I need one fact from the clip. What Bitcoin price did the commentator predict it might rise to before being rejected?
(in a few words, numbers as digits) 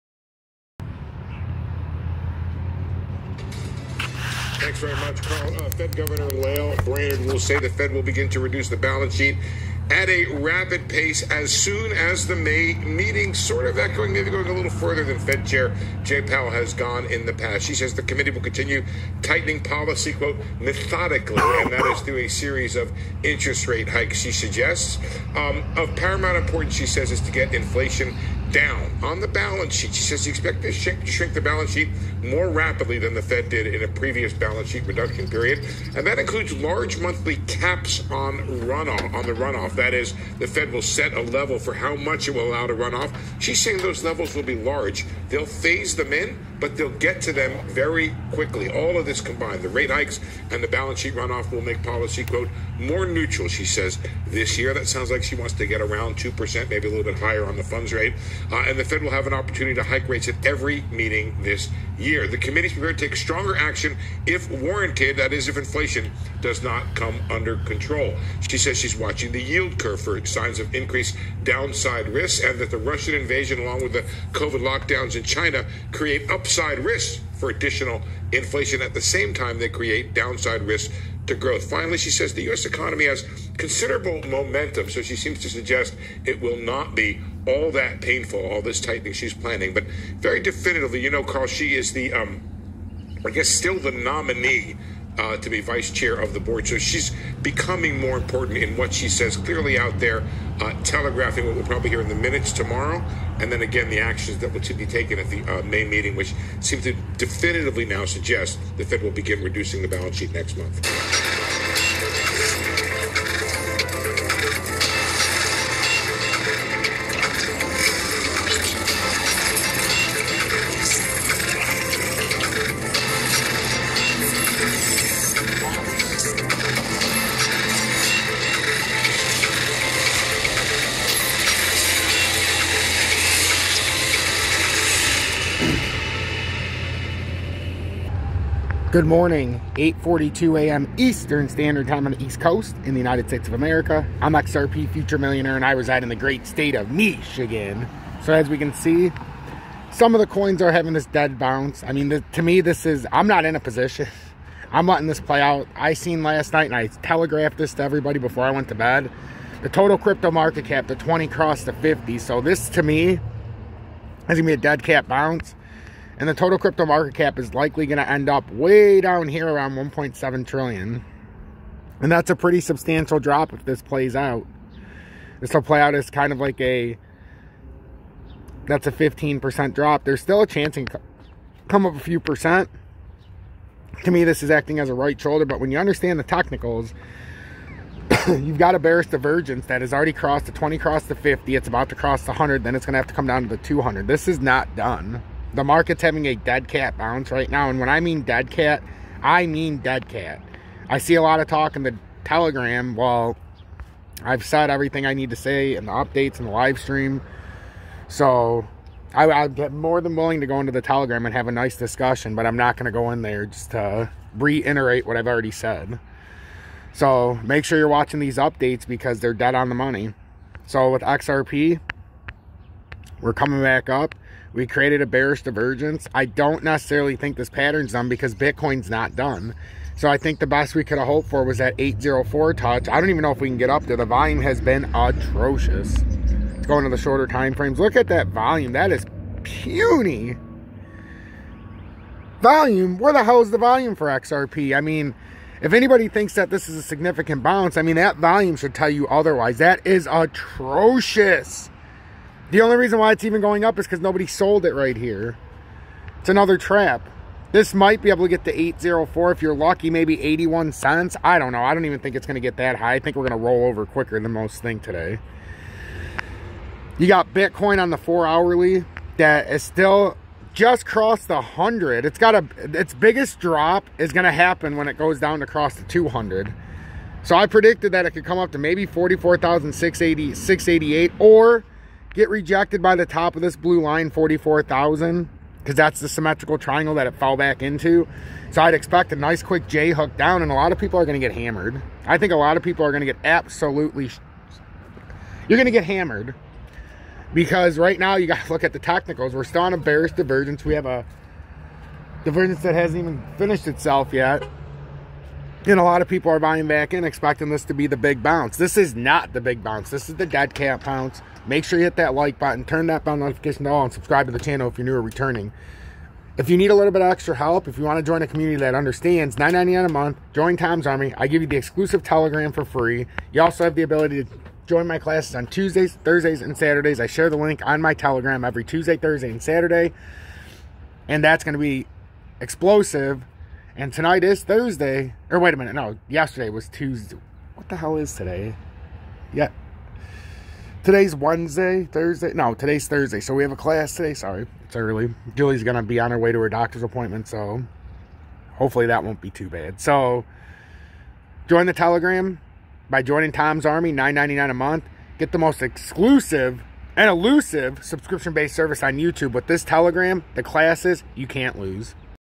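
44,688.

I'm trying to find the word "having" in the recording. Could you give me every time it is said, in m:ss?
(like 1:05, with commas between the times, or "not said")
2:30, 3:16.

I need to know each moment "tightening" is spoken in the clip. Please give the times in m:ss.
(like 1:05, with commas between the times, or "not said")
0:19, 1:28.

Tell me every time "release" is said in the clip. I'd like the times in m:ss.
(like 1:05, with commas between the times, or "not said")
not said.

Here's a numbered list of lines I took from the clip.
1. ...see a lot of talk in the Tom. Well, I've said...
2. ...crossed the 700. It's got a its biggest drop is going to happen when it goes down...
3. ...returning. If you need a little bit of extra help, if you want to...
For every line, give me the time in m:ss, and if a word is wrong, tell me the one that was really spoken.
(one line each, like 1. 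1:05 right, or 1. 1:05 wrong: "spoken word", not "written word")
1. 3:20 wrong: "Telegram", not "Tom"
2. 4:30 wrong: "100", not "700"
3. 5:15 right.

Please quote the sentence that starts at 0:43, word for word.
She's saying those levels will be large.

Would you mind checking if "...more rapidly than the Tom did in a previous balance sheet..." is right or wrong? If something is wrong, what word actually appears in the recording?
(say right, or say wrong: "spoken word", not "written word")
wrong: "Fed", not "Tom".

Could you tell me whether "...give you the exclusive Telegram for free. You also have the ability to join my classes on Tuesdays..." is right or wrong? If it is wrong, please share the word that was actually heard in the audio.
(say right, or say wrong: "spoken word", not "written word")
right.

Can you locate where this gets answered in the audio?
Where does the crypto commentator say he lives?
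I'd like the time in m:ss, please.
2:26.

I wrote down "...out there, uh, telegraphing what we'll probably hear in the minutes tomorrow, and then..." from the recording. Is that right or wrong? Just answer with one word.
right.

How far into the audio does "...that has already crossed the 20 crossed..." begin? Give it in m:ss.
3:09.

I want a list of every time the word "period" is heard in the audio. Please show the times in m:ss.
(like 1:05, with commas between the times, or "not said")
0:35.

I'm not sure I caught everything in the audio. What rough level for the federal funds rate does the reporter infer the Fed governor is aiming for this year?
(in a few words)
2%.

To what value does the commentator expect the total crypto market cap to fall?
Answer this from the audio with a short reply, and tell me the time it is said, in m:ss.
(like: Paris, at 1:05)
1.7 trillion, at 2:49.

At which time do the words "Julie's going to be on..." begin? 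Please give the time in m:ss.
5:45.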